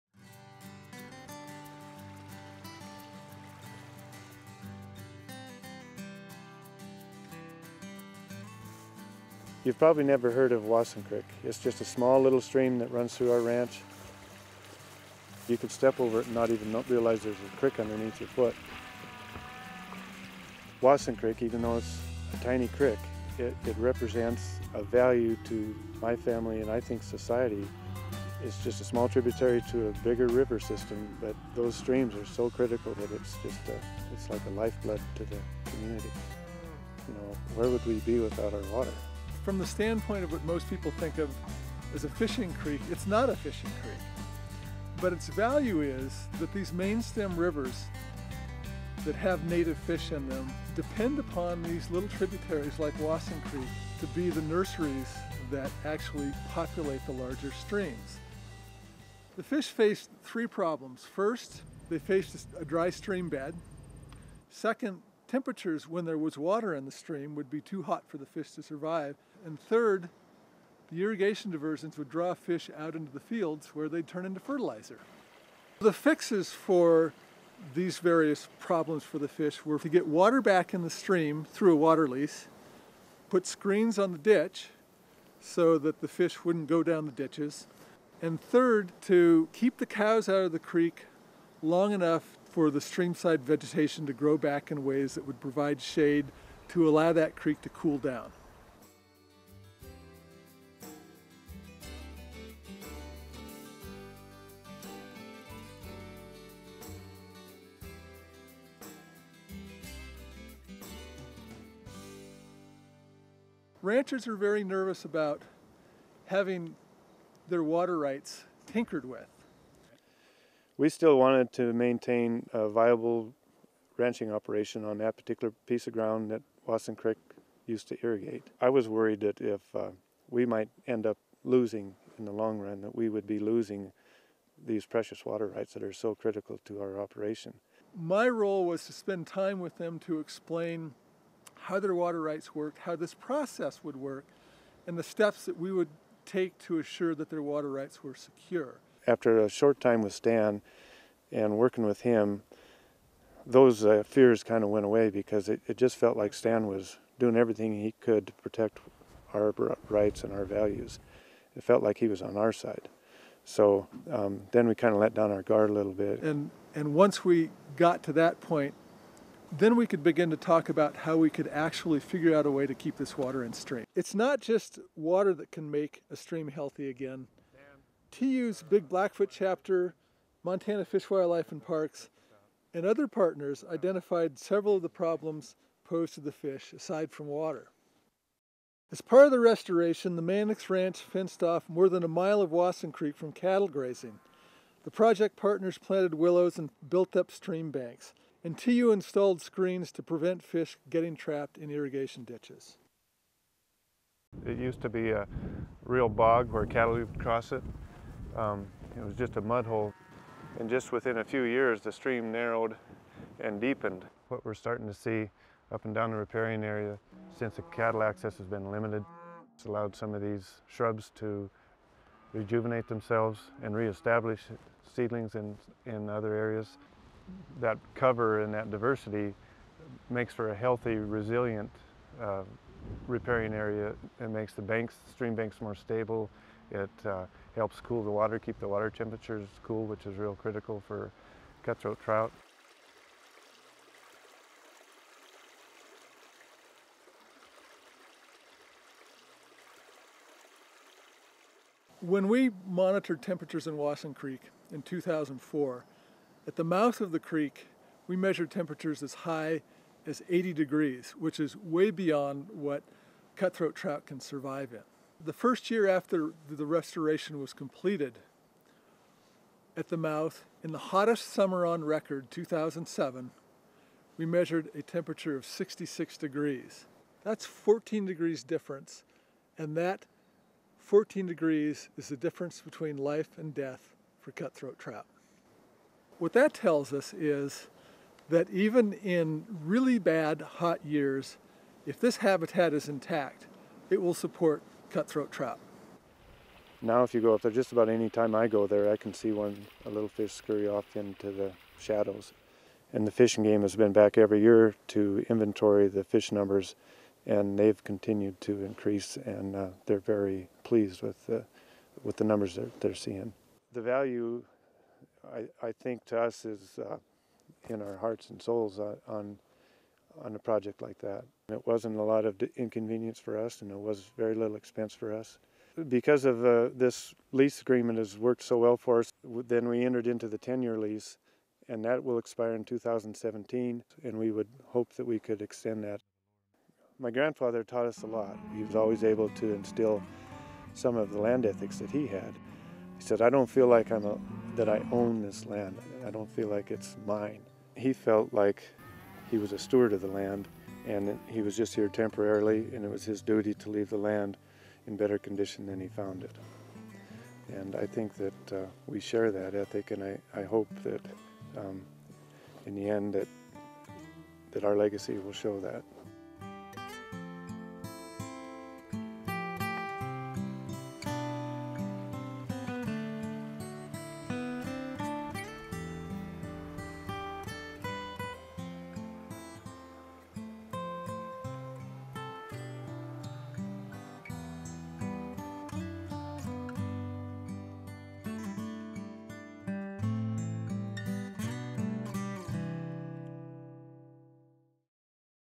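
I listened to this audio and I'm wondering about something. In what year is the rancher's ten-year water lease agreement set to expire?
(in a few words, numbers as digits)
2017.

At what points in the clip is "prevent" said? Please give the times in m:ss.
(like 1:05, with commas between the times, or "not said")
3:20.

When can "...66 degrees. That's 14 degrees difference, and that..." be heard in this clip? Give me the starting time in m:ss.
4:35.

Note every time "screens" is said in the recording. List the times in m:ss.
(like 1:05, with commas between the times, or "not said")
1:23, 3:19.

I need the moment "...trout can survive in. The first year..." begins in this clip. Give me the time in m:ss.
4:23.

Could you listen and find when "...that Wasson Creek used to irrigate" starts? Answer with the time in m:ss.
2:06.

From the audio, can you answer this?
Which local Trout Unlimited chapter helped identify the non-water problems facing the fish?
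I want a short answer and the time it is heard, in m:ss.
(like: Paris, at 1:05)
Big Blackfoot, at 2:58.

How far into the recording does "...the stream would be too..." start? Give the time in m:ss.
1:06.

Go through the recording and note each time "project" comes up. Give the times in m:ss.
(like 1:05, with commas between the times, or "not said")
3:14, 5:20.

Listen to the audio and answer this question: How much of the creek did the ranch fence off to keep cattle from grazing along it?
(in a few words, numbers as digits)
more than a mile.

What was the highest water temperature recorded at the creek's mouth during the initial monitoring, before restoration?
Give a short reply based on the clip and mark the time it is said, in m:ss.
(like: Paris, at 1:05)
80 degrees, at 4:20.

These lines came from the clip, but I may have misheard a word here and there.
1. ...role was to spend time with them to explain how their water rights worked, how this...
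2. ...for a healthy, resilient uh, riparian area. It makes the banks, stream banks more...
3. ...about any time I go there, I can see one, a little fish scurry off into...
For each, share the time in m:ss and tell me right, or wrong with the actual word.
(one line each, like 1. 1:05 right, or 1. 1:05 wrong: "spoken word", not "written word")
1. 2:18 right
2. 3:50 right
3. 4:57 right.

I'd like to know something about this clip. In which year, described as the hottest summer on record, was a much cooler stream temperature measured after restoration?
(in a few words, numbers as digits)
2007.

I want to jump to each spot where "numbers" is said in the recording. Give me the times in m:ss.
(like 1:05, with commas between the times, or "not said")
5:06, 5:12.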